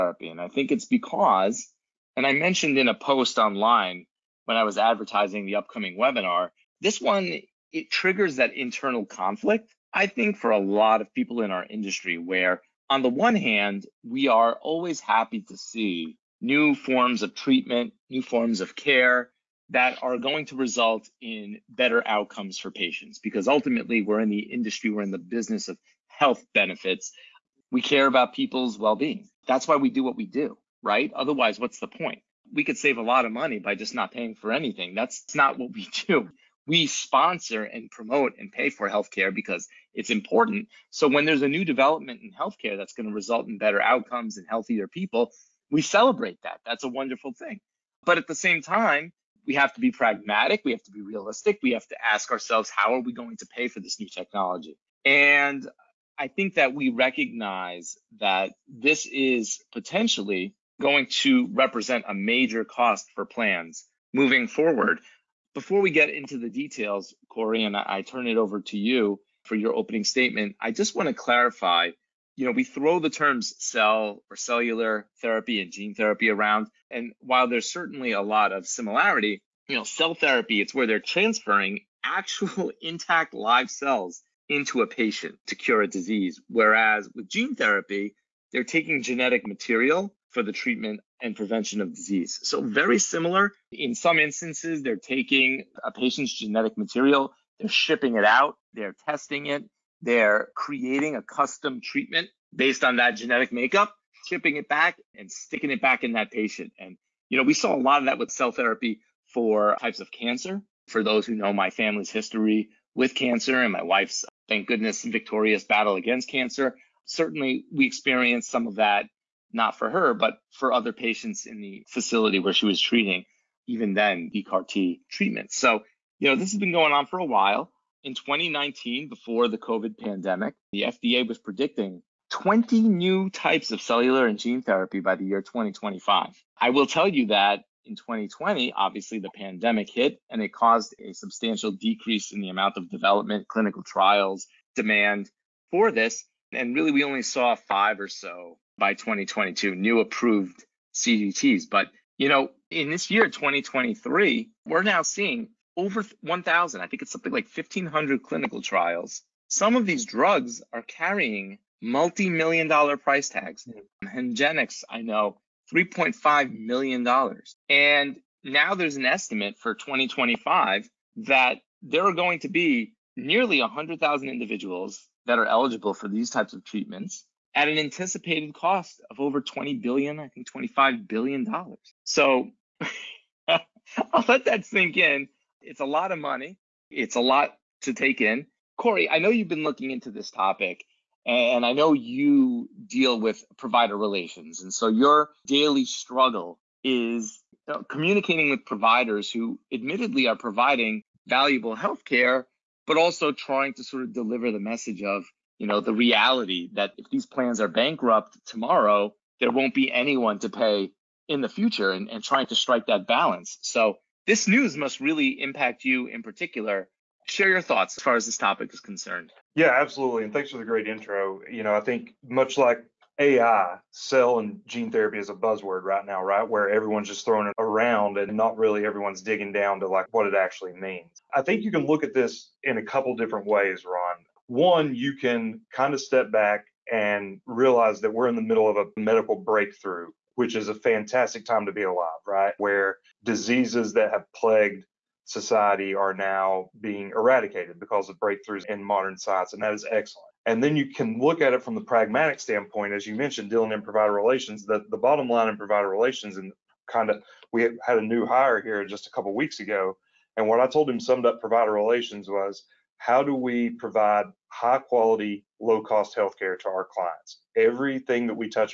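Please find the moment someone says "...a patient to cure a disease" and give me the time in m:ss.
1:24.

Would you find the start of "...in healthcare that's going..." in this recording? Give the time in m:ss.
0:42.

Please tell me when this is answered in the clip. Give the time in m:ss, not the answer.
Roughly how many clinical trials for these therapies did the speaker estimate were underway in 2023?
2:37.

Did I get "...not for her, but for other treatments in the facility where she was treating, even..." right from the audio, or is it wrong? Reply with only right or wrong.
wrong.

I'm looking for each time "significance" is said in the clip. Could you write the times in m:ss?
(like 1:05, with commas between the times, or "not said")
not said.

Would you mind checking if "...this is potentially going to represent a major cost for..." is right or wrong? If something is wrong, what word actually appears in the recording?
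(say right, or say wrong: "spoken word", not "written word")
right.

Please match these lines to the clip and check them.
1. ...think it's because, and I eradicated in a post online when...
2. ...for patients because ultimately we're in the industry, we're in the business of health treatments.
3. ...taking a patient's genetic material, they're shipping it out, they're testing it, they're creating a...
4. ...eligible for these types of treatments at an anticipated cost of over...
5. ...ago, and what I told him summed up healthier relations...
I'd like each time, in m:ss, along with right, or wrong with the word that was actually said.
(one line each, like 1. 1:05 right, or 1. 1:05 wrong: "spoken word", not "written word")
1. 0:00 wrong: "mentioned", not "eradicated"
2. 0:22 wrong: "benefits", not "treatments"
3. 1:34 right
4. 2:55 right
5. 4:19 wrong: "provider", not "healthier".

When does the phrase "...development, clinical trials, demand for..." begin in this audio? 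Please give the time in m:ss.
2:22.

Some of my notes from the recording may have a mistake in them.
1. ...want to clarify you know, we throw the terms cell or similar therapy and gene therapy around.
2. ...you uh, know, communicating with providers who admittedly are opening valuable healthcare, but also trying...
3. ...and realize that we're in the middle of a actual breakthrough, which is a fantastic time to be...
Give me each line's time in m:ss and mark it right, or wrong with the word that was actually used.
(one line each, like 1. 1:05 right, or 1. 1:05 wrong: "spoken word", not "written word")
1. 1:10 wrong: "cellular", not "similar"
2. 3:17 wrong: "providing", not "opening"
3. 3:56 wrong: "medical", not "actual".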